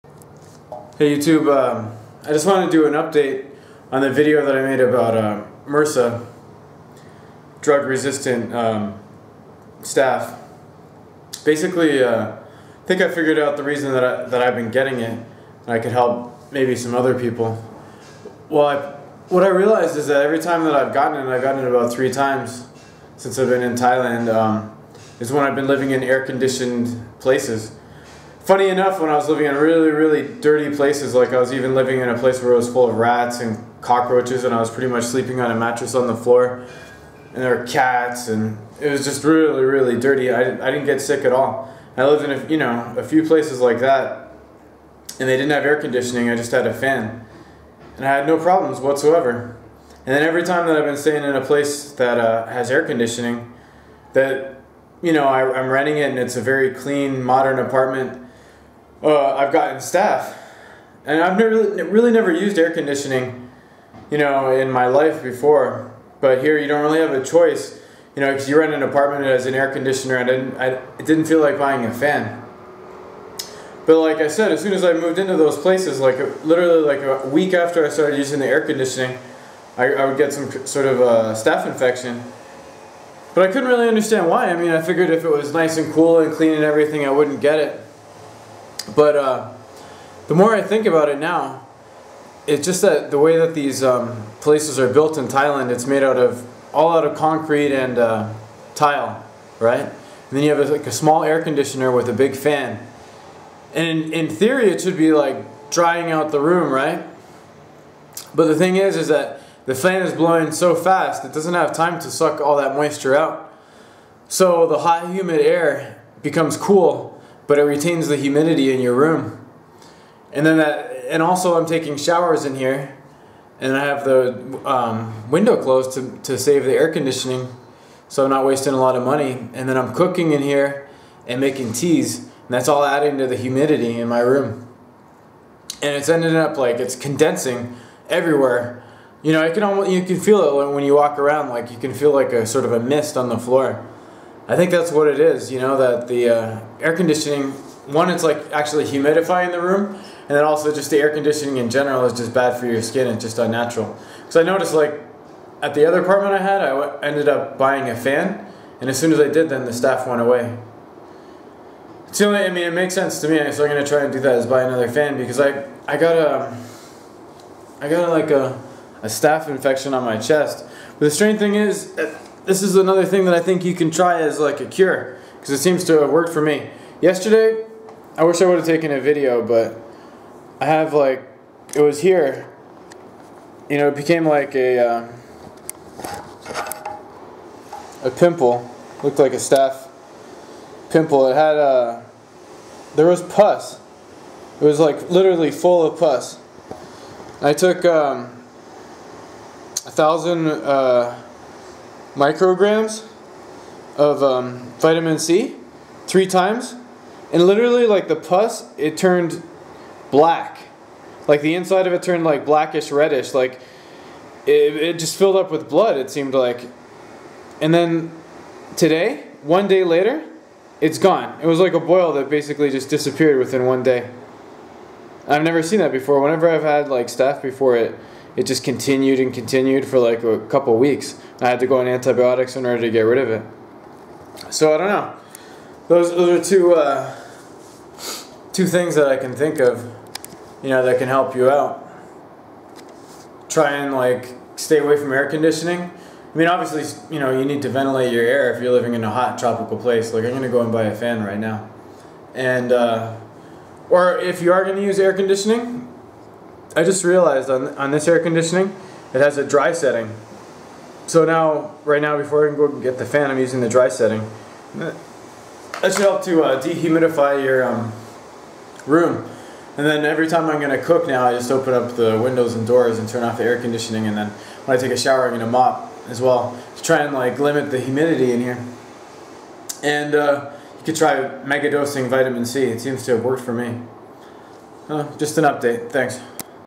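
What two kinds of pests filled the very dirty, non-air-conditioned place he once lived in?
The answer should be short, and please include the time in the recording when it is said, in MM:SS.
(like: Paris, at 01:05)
Rats and cockroaches, at 00:32.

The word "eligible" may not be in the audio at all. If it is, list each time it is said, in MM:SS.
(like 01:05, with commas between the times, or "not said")
not said.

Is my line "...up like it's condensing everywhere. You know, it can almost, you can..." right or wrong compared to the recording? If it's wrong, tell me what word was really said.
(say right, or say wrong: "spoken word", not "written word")
right.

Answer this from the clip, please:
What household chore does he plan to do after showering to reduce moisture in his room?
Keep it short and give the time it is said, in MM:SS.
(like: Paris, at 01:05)
Mop, at 04:35.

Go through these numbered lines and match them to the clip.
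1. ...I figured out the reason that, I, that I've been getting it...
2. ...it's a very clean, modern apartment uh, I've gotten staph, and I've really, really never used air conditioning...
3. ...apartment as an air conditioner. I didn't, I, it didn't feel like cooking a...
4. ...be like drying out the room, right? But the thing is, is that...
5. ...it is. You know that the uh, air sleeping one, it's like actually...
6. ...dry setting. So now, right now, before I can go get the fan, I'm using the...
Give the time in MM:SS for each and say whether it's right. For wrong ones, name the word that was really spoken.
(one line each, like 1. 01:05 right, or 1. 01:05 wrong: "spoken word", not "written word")
1. 00:13 right
2. 00:56 right
3. 01:08 wrong: "buying", not "cooking"
4. 01:44 right
5. 02:25 wrong: "conditioning", not "sleeping"
6. 04:19 right.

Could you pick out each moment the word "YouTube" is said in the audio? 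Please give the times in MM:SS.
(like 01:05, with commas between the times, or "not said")
00:01.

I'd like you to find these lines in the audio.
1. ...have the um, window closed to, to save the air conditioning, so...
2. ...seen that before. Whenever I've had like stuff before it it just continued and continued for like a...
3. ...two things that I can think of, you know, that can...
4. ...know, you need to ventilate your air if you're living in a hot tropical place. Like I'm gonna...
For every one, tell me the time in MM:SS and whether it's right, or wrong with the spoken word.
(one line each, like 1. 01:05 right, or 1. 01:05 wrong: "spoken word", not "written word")
1. 02:03 right
2. 03:45 right
3. 03:58 right
4. 04:07 right.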